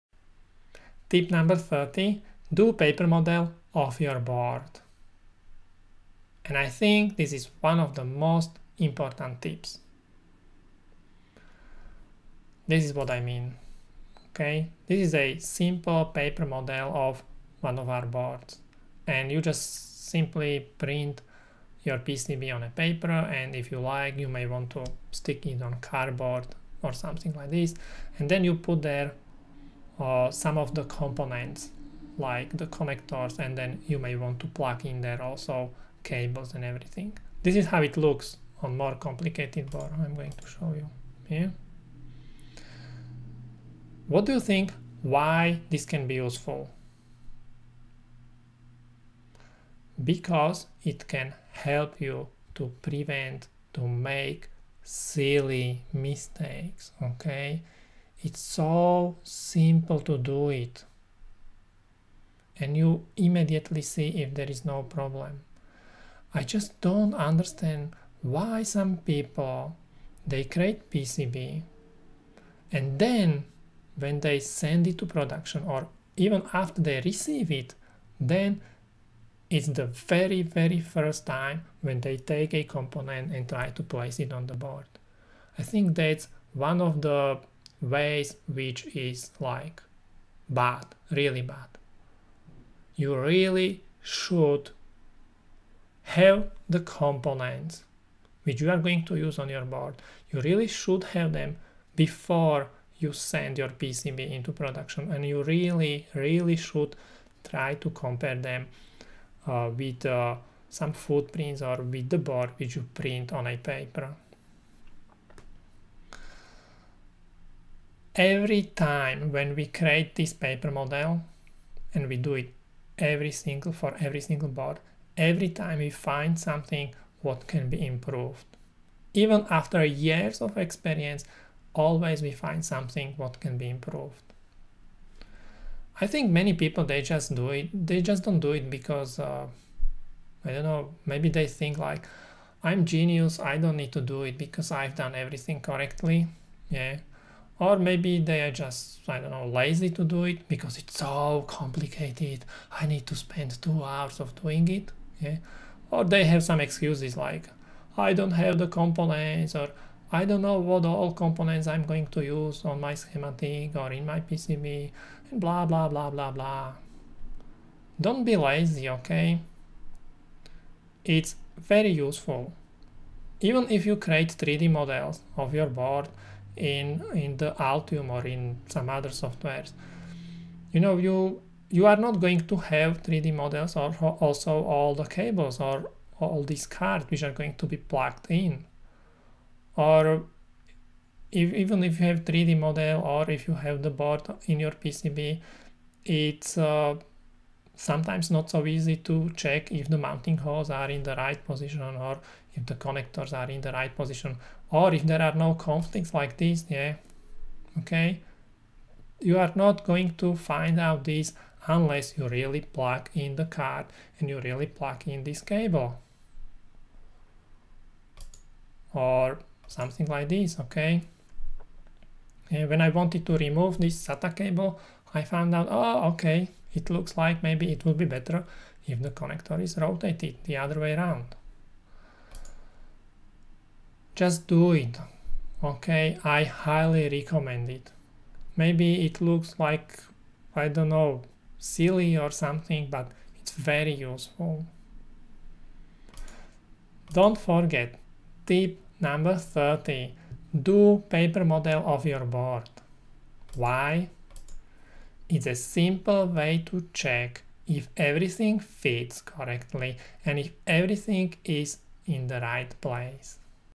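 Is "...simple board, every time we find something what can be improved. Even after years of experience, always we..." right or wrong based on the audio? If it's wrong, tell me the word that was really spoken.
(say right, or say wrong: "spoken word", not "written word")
wrong: "single", not "simple".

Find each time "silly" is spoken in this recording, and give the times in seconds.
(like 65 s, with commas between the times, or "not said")
54 s, 241 s.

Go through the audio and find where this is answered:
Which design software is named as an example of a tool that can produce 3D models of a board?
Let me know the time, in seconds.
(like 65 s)
177 s.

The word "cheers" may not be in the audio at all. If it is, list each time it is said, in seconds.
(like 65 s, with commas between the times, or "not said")
not said.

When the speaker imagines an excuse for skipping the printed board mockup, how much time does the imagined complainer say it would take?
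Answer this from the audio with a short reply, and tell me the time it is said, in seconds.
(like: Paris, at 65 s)
2 hours, at 153 s.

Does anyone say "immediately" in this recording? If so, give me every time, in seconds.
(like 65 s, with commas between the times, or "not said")
63 s.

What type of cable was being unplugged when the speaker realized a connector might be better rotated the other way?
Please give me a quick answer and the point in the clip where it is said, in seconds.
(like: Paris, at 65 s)
SATA, at 224 s.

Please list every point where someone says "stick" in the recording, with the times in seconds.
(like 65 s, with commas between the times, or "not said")
25 s.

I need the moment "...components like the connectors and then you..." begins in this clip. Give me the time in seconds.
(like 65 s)
30 s.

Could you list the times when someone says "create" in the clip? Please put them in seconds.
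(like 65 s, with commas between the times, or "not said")
70 s, 119 s, 173 s.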